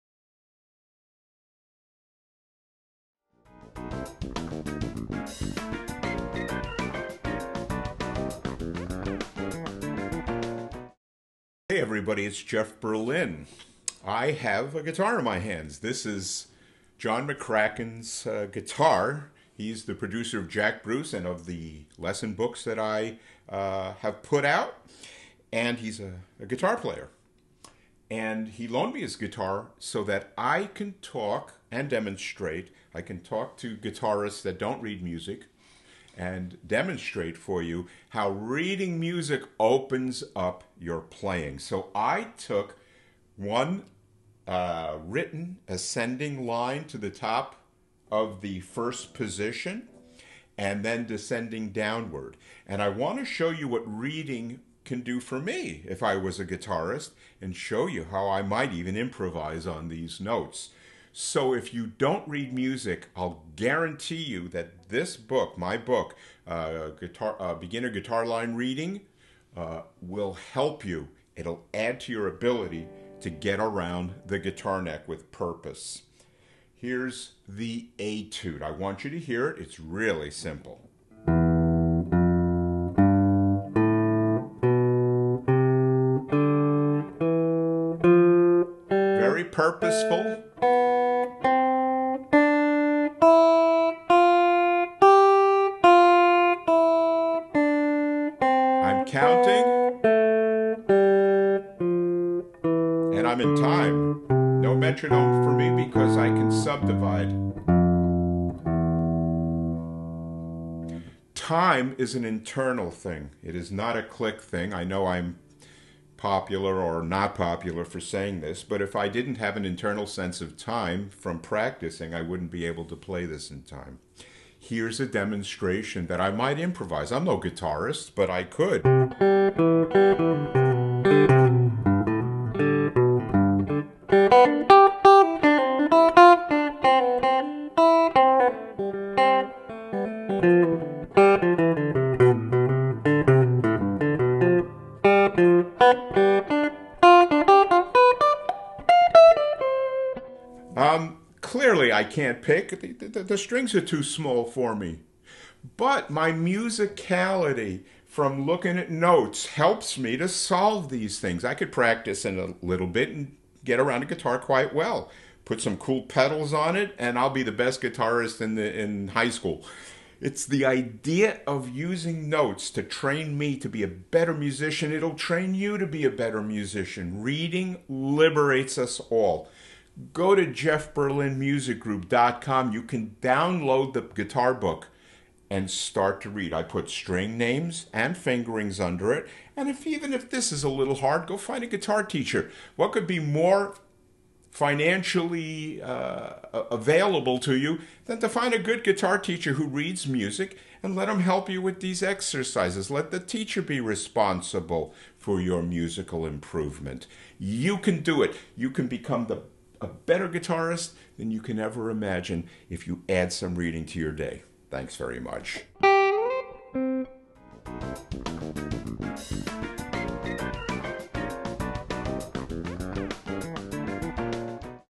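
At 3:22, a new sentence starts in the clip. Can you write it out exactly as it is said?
Let the teacher be responsible for your musical improvement.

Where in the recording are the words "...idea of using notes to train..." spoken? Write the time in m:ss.
2:50.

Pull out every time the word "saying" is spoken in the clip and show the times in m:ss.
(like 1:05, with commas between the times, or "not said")
1:57.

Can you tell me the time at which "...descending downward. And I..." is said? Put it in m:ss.
0:51.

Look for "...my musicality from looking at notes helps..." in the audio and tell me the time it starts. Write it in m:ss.
2:36.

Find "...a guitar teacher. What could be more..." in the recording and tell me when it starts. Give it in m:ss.
3:11.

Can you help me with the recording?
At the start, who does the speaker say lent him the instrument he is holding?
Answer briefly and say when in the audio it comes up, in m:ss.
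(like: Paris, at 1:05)
John McCracken, at 0:16.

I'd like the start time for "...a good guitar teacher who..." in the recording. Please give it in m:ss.
3:18.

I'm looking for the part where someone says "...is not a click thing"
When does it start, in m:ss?
1:53.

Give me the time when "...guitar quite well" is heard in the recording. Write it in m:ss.
2:44.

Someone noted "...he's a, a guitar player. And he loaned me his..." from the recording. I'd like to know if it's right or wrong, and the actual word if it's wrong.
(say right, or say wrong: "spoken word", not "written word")
right.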